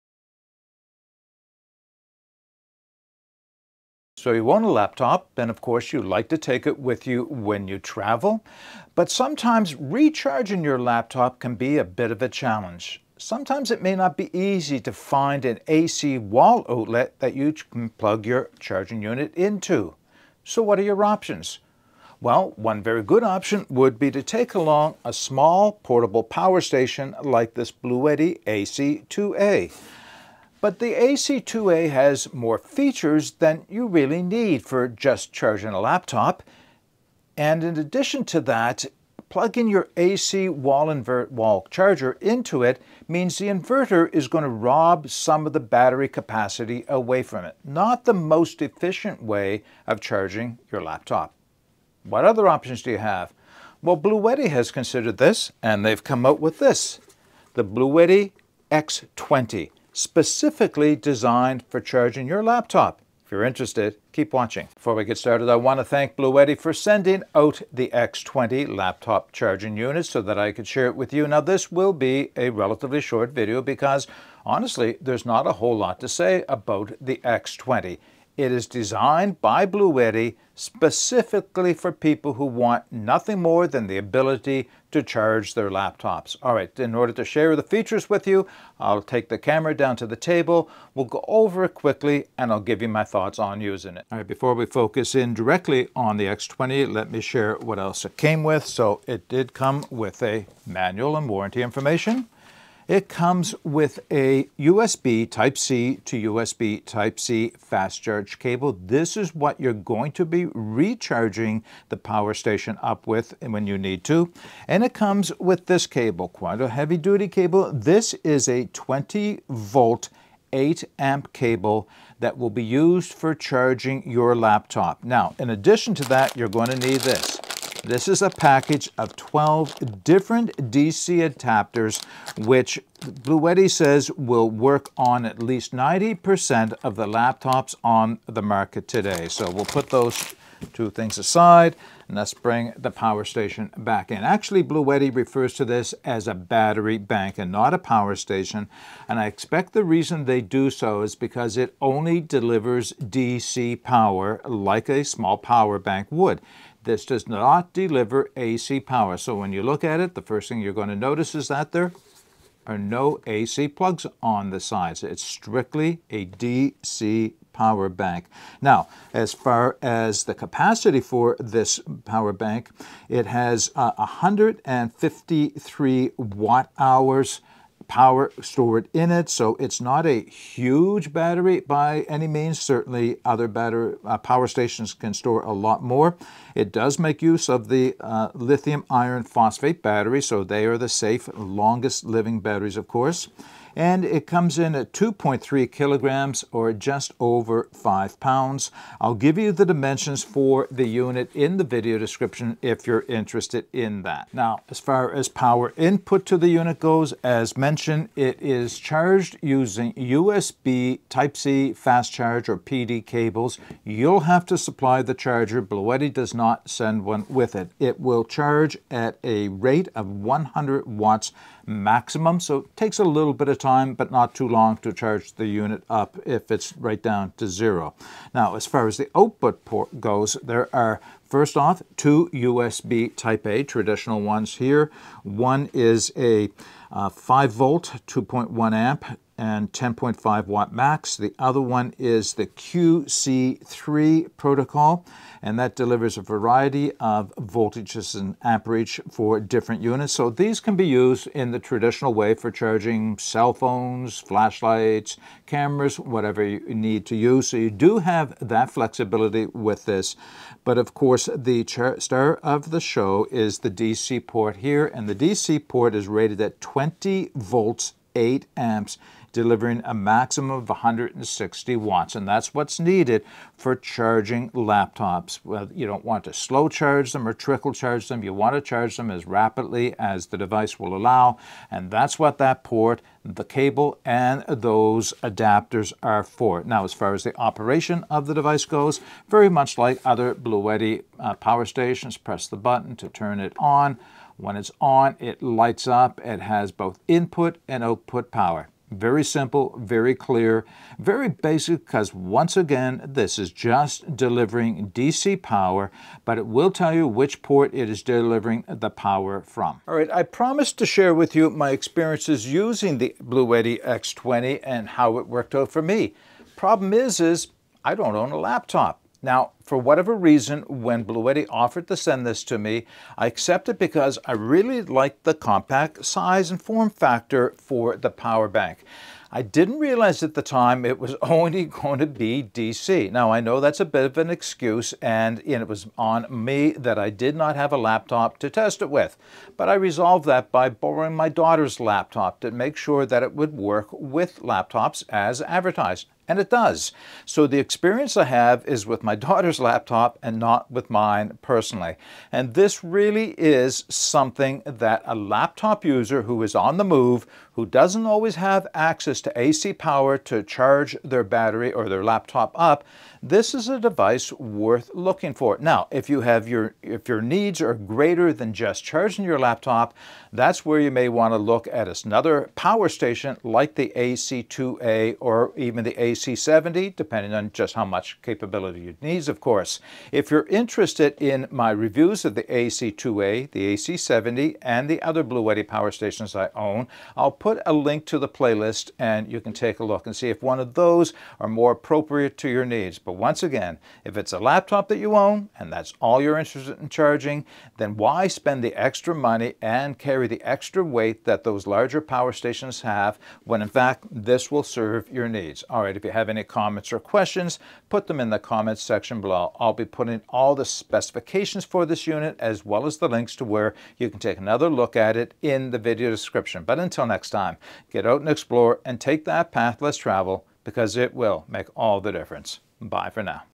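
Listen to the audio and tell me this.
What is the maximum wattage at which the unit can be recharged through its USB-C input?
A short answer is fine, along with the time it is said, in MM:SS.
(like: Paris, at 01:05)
100 watts, at 03:40.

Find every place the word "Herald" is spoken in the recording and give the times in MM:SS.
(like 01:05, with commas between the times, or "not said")
not said.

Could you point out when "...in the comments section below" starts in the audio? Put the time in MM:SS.
06:48.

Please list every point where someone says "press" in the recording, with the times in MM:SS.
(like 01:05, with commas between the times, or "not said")
04:52.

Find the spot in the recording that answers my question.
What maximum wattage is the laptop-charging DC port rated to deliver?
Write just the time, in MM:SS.
04:30.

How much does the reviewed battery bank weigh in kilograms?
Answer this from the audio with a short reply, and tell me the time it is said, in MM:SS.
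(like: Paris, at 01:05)
2.3 kilograms, at 03:14.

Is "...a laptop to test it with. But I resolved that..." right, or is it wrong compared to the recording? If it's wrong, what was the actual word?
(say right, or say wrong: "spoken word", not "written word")
right.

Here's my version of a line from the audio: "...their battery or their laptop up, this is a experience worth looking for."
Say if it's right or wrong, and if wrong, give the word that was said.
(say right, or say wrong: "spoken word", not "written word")
wrong: "device", not "experience".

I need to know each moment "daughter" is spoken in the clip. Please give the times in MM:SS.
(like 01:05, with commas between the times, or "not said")
05:41, 05:49.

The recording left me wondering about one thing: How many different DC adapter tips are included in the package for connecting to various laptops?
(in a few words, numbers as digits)
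12.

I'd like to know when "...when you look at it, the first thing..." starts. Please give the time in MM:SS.
02:39.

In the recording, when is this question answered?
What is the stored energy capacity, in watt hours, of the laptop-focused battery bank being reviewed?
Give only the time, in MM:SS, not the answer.
02:53.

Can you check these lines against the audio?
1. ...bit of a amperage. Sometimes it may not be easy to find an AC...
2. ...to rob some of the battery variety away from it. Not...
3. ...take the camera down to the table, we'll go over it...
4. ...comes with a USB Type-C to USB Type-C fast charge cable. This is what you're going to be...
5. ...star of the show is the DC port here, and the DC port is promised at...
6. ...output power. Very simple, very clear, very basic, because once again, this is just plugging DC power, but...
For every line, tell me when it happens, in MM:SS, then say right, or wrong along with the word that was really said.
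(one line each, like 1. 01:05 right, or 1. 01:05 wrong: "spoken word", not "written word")
1. 00:11 wrong: "challenge", not "amperage"
2. 00:44 wrong: "capacity", not "variety"
3. 01:29 right
4. 01:43 right
5. 04:21 wrong: "rated", not "promised"
6. 04:57 wrong: "delivering", not "plugging".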